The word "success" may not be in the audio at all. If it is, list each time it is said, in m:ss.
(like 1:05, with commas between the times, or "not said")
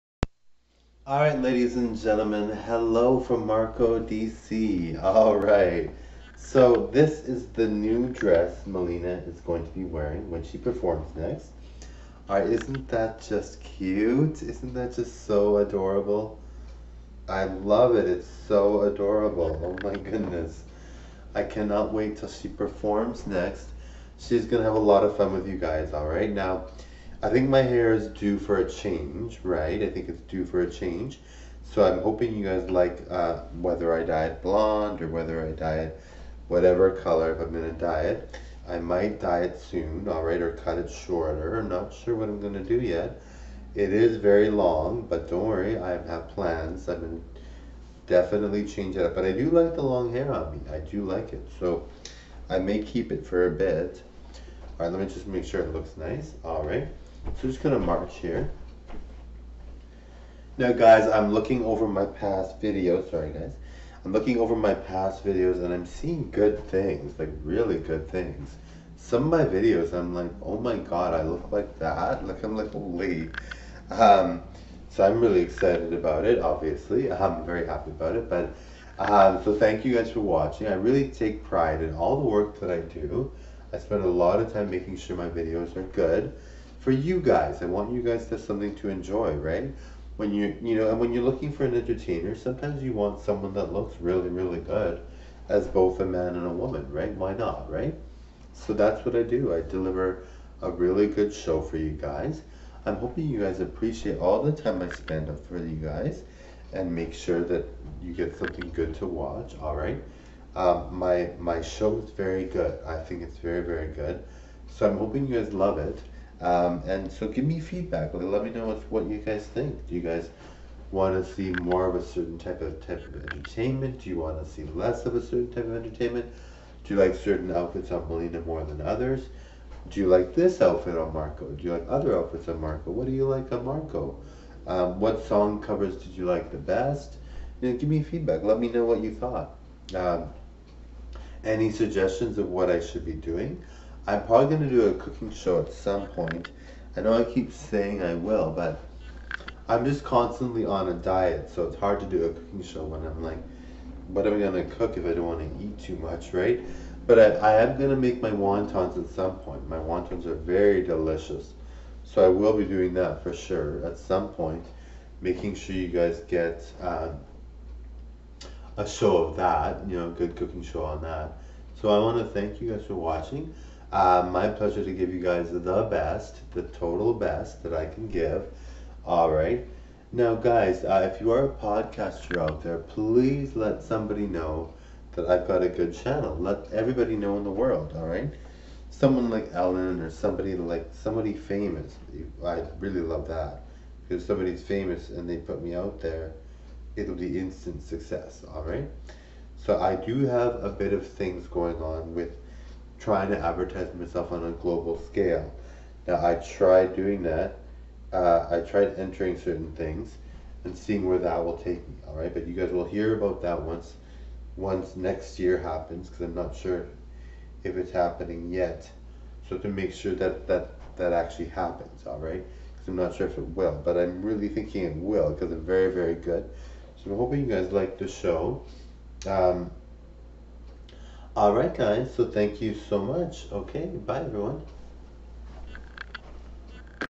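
3:17.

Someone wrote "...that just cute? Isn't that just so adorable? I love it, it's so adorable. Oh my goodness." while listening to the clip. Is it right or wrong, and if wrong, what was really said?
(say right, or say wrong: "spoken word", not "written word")
right.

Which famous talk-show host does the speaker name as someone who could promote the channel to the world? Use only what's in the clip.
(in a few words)
Ellen.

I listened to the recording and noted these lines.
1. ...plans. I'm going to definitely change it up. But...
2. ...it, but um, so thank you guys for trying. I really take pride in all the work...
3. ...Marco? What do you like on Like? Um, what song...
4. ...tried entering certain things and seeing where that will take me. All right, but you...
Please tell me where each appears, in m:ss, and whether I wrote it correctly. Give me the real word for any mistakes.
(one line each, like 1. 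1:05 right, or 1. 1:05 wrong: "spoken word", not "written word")
1. 0:46 right
2. 1:18 wrong: "watching", not "trying"
3. 2:12 wrong: "Marco", not "Like"
4. 3:28 right.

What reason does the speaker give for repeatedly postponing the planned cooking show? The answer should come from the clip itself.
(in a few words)
Constantly on a diet.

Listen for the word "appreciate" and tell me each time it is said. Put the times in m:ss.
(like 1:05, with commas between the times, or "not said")
1:43.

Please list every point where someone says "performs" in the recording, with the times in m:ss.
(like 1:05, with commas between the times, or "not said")
0:10, 0:22.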